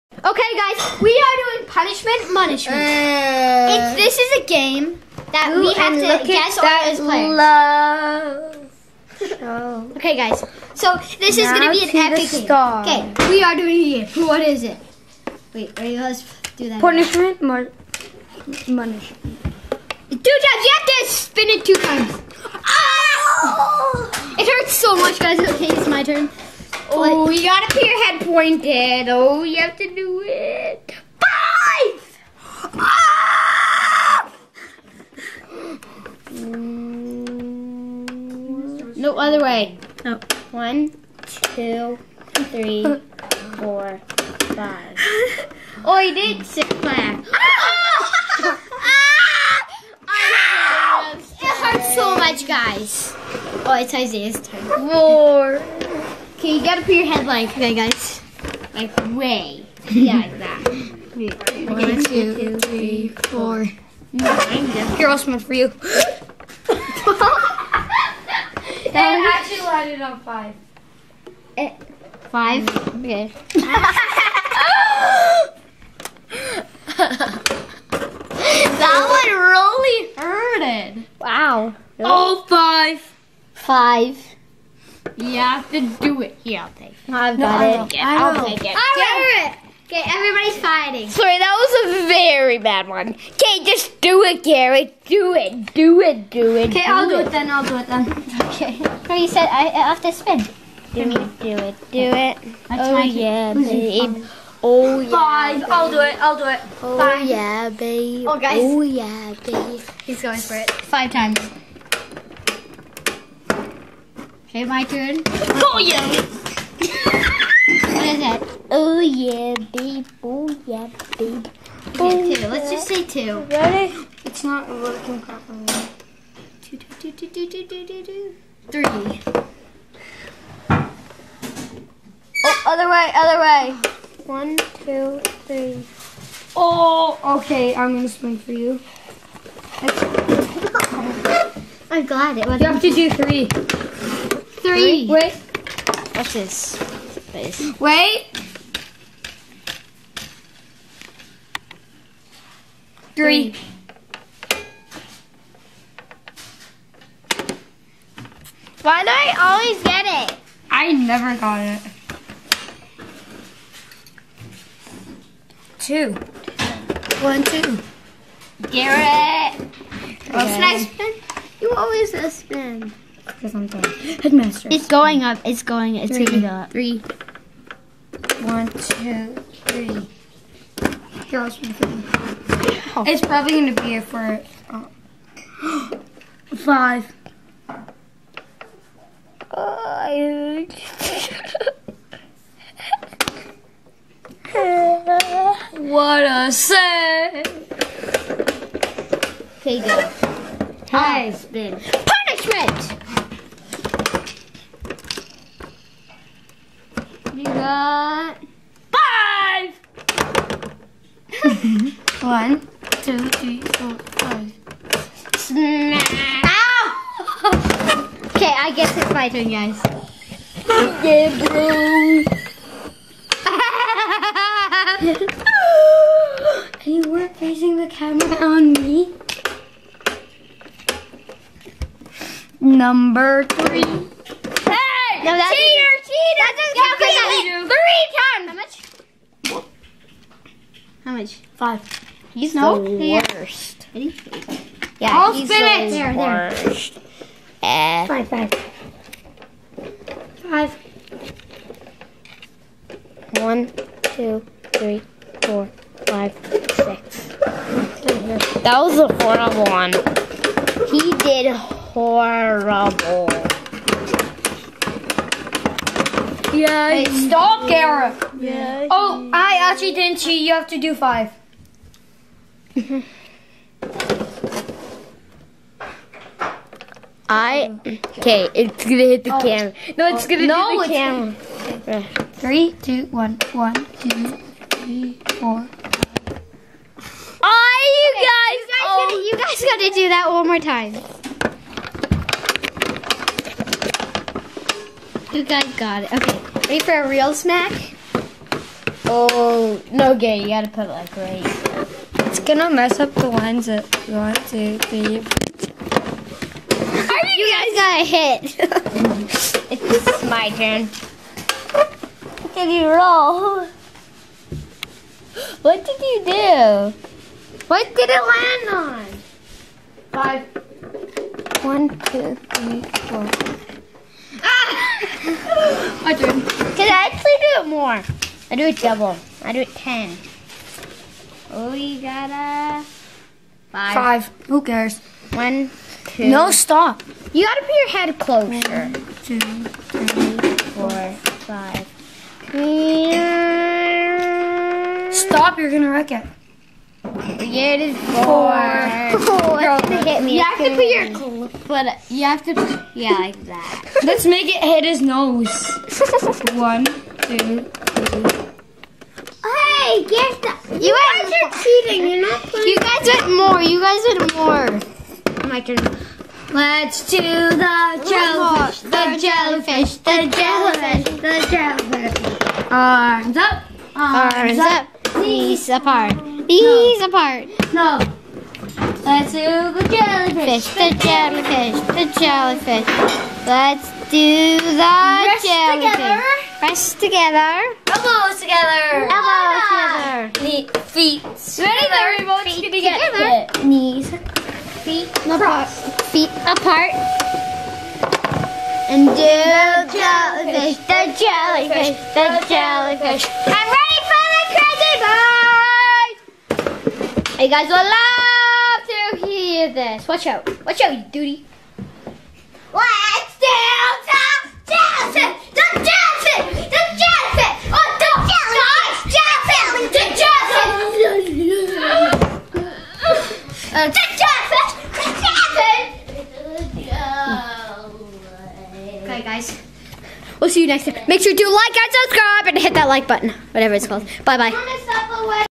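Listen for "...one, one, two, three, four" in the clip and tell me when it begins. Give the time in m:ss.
4:43.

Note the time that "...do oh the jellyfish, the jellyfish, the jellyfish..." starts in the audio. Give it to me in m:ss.
6:07.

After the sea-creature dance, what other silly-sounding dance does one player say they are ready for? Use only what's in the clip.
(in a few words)
The crazy bird.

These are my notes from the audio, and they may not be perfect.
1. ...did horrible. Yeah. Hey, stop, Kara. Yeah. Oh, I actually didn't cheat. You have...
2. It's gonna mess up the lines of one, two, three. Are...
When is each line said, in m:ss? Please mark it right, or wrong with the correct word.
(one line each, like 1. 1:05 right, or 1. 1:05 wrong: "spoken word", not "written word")
1. 4:21 right
2. 5:02 right.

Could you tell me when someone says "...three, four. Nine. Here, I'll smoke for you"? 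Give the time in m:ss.
1:04.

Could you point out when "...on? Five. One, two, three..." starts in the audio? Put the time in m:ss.
5:18.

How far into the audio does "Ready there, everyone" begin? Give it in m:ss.
6:31.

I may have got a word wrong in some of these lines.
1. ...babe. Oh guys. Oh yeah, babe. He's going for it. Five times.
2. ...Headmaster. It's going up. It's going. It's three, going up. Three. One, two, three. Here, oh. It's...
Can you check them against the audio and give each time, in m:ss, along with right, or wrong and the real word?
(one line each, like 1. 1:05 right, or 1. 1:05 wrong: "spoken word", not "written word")
1. 1:47 right
2. 2:54 right.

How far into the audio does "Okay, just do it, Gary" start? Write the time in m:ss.
1:33.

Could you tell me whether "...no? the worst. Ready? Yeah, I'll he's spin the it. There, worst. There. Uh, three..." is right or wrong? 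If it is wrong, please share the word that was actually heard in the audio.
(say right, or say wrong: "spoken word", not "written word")
wrong: "five", not "three".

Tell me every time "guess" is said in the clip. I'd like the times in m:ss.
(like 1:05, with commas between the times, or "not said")
0:06, 3:38.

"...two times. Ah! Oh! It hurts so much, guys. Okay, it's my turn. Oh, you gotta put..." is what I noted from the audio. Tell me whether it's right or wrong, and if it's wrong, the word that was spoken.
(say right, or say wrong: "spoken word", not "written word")
right.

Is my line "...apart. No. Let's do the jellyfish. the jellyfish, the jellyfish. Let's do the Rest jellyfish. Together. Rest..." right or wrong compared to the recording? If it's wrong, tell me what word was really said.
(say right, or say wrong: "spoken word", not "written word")
right.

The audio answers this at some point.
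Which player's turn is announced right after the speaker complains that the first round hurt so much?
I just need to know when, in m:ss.
0:53.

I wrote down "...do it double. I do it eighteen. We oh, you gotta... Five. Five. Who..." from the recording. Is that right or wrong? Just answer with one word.
wrong.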